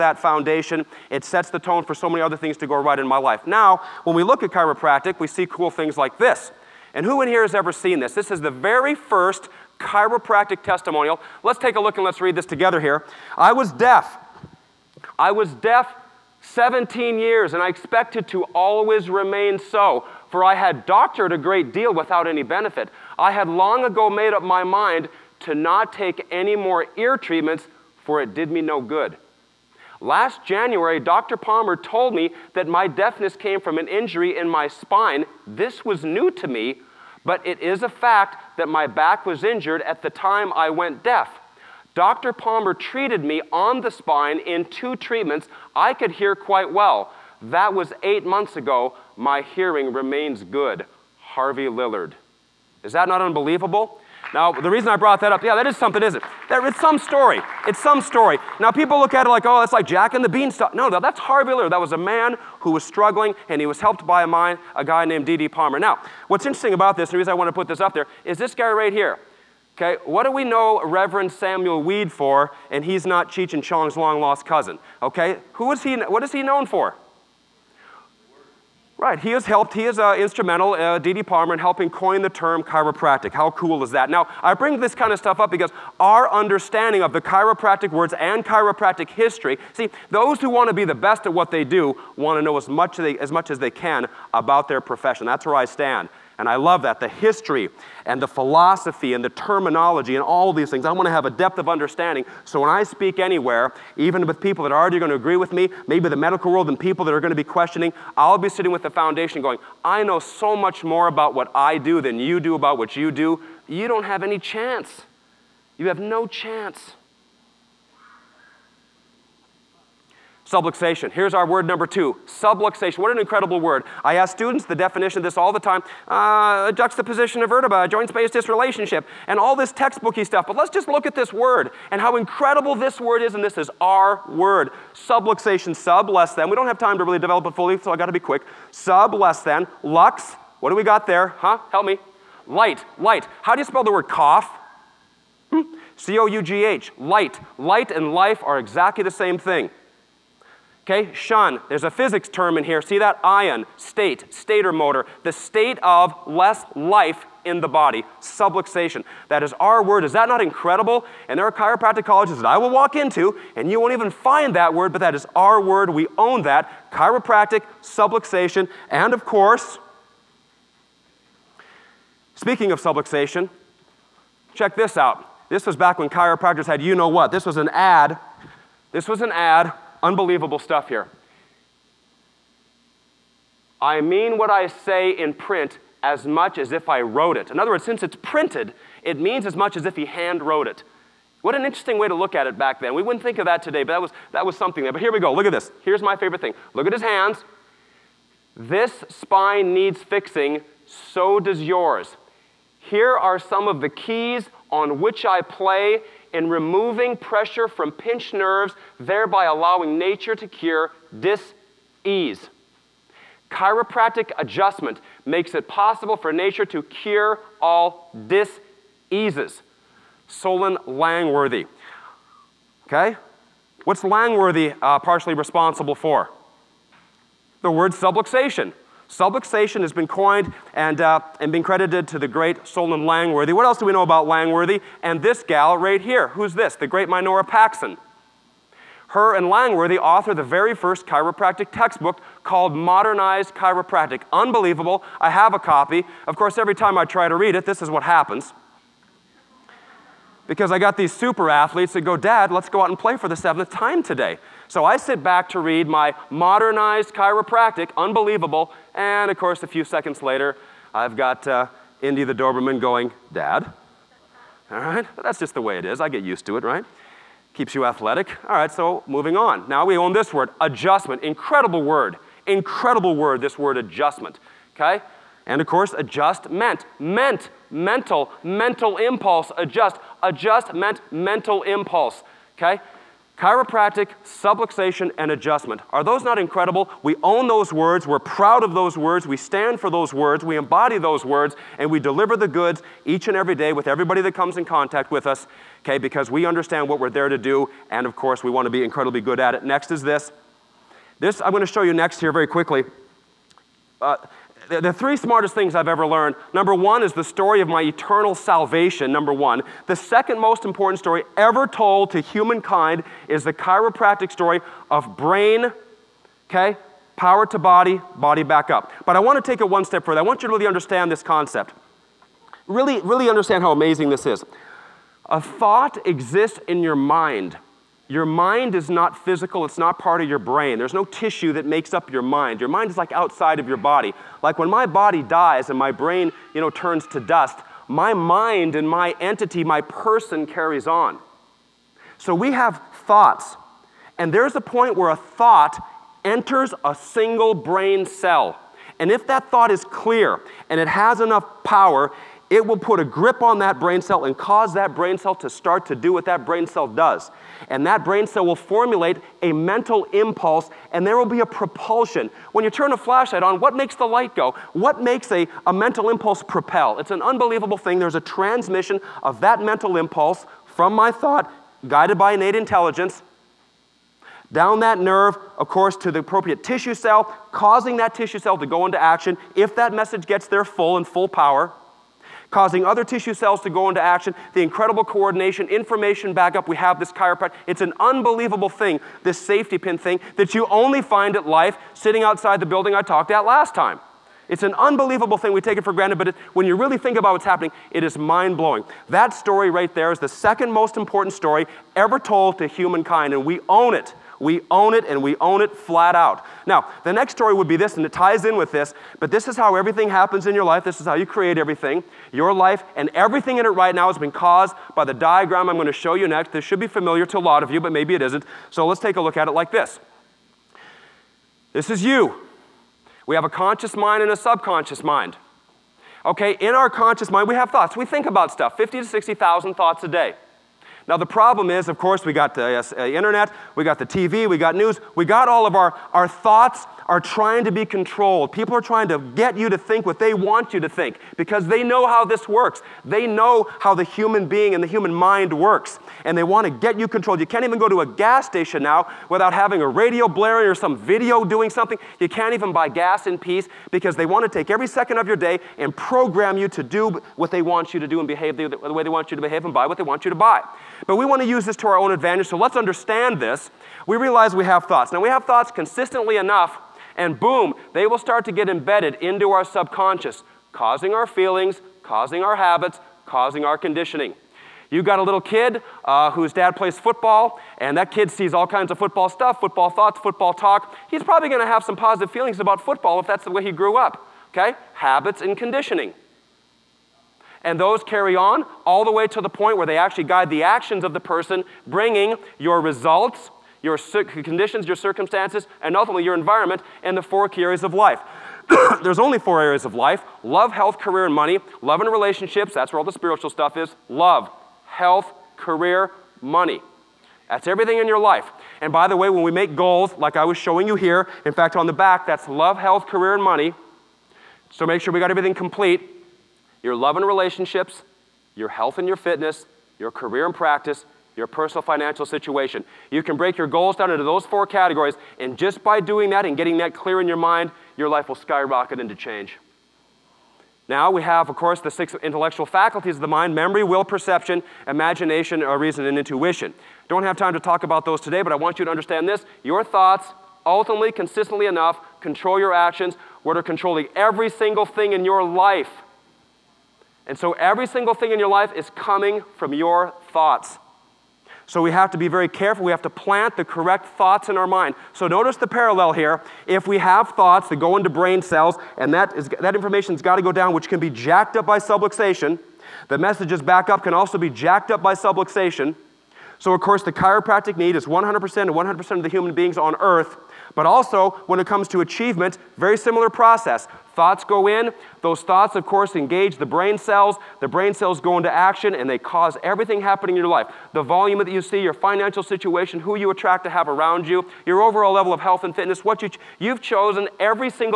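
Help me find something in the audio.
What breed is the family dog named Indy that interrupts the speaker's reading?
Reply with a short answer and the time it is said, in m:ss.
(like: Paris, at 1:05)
Doberman, at 4:22.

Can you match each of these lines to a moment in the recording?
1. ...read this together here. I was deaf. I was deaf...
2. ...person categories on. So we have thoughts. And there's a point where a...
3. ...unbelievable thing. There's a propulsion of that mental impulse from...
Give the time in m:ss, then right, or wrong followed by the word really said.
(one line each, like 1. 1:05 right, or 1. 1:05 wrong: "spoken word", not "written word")
1. 0:12 right
2. 5:39 wrong: "carries", not "categories"
3. 6:07 wrong: "transmission", not "propulsion".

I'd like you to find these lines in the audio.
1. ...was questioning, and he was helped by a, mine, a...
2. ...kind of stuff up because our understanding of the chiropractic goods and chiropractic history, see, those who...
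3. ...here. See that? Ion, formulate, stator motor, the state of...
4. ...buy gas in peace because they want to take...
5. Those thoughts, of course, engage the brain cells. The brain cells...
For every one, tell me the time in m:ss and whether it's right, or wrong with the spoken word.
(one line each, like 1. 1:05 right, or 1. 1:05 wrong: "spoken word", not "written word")
1. 1:02 wrong: "struggling", not "questioning"
2. 1:24 wrong: "words", not "goods"
3. 2:32 wrong: "state", not "formulate"
4. 7:32 right
5. 9:35 right.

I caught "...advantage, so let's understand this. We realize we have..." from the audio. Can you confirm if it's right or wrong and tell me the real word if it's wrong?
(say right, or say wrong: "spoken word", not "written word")
right.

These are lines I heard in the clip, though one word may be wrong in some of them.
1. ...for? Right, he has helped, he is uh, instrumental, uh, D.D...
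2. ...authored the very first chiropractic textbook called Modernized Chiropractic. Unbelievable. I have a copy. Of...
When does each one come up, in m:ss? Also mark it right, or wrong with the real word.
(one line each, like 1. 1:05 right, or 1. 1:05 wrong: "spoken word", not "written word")
1. 1:16 right
2. 3:59 right.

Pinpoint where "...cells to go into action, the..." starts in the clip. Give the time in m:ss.
6:23.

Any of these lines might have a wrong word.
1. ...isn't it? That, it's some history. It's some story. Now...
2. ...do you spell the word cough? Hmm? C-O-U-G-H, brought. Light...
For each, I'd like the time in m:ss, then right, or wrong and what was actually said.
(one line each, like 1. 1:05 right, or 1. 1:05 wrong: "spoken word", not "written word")
1. 0:56 wrong: "story", not "history"
2. 2:23 wrong: "light", not "brought".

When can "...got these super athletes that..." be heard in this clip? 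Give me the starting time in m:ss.
4:10.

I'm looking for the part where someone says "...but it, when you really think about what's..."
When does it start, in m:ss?
6:36.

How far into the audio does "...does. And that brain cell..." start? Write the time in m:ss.
5:56.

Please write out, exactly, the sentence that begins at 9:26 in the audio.
So, of course, the chiropractic need is 100% of 100% of the human beings on earth.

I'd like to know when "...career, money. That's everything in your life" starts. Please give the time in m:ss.
8:25.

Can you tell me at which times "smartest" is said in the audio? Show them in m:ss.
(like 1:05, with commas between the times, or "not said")
5:05.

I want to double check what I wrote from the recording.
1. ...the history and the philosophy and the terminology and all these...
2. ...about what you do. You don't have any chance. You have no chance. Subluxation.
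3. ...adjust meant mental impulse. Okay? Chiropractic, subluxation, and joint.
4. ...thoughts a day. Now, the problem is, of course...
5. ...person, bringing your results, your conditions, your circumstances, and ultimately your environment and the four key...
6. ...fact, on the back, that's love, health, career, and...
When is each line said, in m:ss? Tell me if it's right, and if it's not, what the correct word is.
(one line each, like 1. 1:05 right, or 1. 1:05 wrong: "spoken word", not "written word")
1. 1:36 right
2. 1:52 right
3. 4:40 wrong: "adjustment", not "joint"
4. 7:09 right
5. 8:11 right
6. 8:31 right.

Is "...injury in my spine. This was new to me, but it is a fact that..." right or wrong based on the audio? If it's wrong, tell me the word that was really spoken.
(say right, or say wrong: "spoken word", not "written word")
right.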